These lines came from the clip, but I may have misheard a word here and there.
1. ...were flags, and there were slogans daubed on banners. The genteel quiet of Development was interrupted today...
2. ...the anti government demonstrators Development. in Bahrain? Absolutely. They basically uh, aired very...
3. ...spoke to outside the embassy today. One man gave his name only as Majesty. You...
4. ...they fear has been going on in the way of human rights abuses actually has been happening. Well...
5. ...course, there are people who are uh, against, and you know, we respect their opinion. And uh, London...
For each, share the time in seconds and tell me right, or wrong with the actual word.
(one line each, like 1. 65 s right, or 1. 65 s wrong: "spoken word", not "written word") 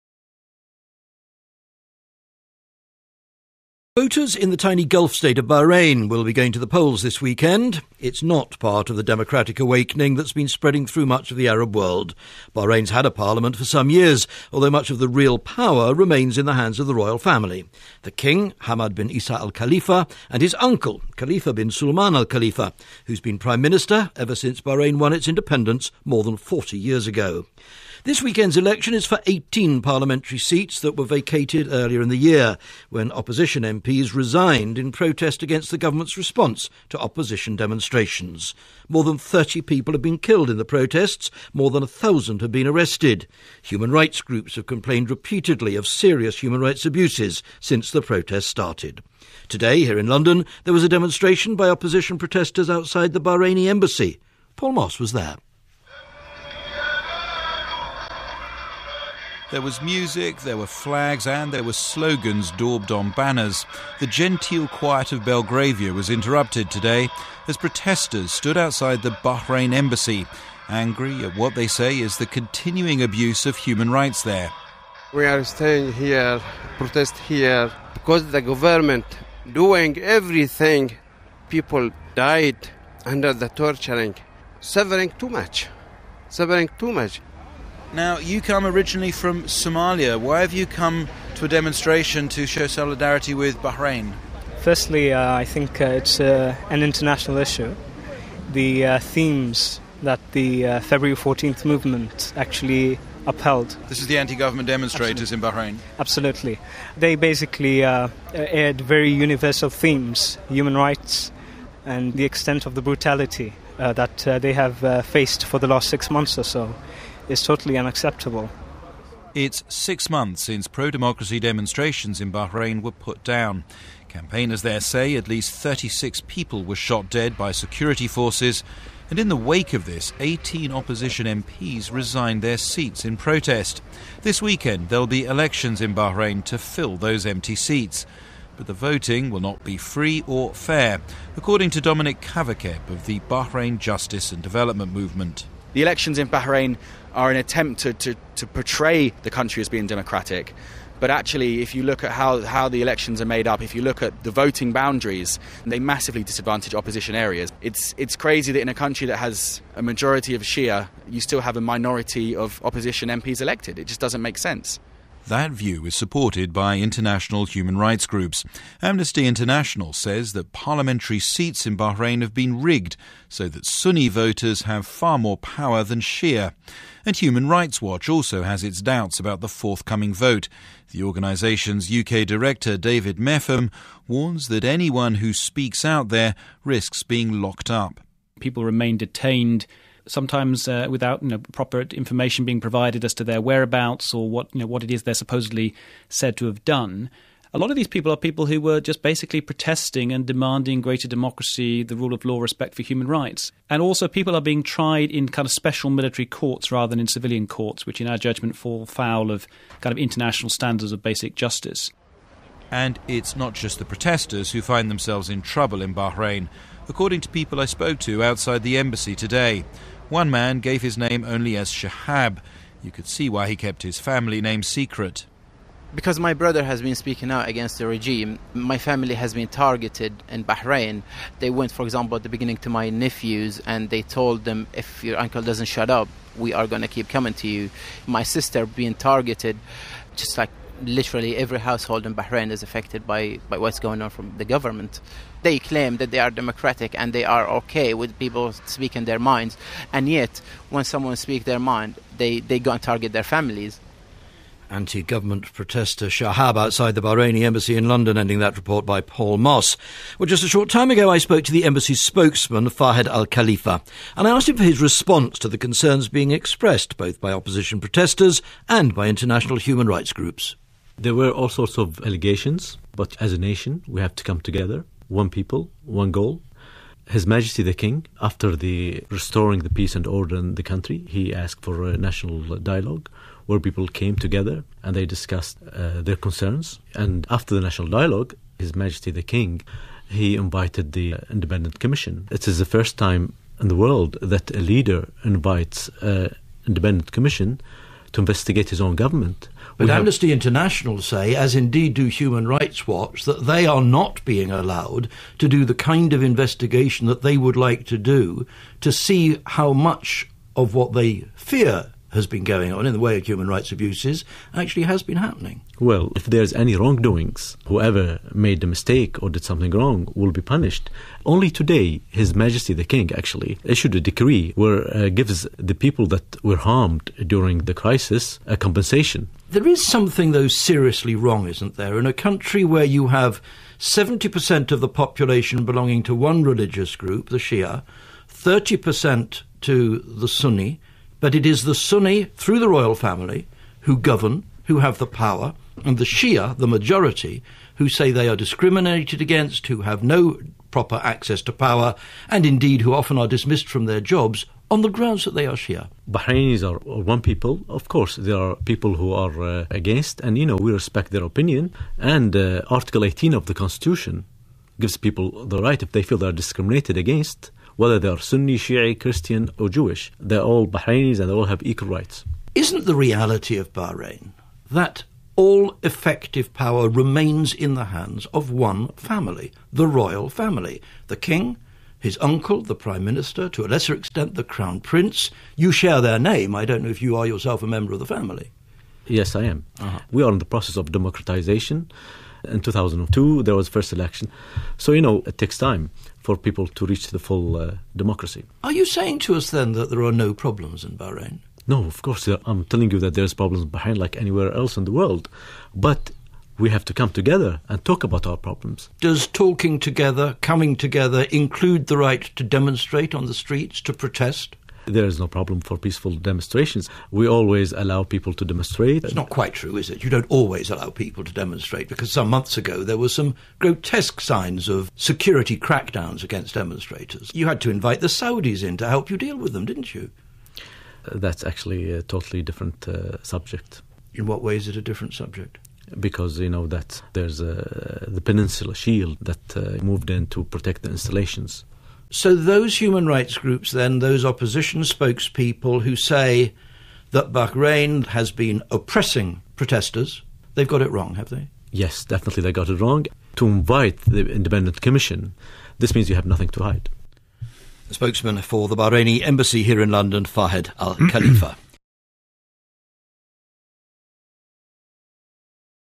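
1. 60 s wrong: "Belgravia", not "Development"
2. 104 s wrong: "Absolutely", not "Development"
3. 217 s wrong: "Shahab", not "Majesty"
4. 310 s right
5. 357 s wrong: "Article", not "London".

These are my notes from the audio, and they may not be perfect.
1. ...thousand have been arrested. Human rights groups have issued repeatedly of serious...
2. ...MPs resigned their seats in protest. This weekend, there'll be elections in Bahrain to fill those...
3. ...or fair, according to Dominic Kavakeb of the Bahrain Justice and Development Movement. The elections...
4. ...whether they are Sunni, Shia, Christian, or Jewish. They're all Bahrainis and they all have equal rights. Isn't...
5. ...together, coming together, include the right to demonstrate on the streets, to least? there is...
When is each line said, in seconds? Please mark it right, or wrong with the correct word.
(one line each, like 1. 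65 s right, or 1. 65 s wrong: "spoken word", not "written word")
1. 41 s wrong: "complained", not "issued"
2. 131 s right
3. 140 s right
4. 367 s right
5. 409 s wrong: "protest", not "least".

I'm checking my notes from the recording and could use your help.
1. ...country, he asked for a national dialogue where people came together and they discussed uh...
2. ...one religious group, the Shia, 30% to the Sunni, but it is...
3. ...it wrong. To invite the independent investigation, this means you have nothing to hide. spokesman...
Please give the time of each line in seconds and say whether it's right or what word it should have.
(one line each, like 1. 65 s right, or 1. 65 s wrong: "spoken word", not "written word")
1. 280 s right
2. 336 s right
3. 452 s wrong: "commission", not "investigation".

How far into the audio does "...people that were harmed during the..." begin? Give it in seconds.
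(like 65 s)
325 s.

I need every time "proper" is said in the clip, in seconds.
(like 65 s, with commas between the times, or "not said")
191 s, 350 s.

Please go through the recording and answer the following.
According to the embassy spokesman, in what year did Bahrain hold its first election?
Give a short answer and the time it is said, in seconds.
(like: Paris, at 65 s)
2002, at 392 s.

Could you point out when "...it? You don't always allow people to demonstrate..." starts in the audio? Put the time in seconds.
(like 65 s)
419 s.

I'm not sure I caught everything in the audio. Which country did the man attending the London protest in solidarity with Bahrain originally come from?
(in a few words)
Somalia.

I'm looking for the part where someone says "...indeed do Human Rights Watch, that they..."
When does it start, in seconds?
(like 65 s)
301 s.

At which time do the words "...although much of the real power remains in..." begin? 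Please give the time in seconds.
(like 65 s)
14 s.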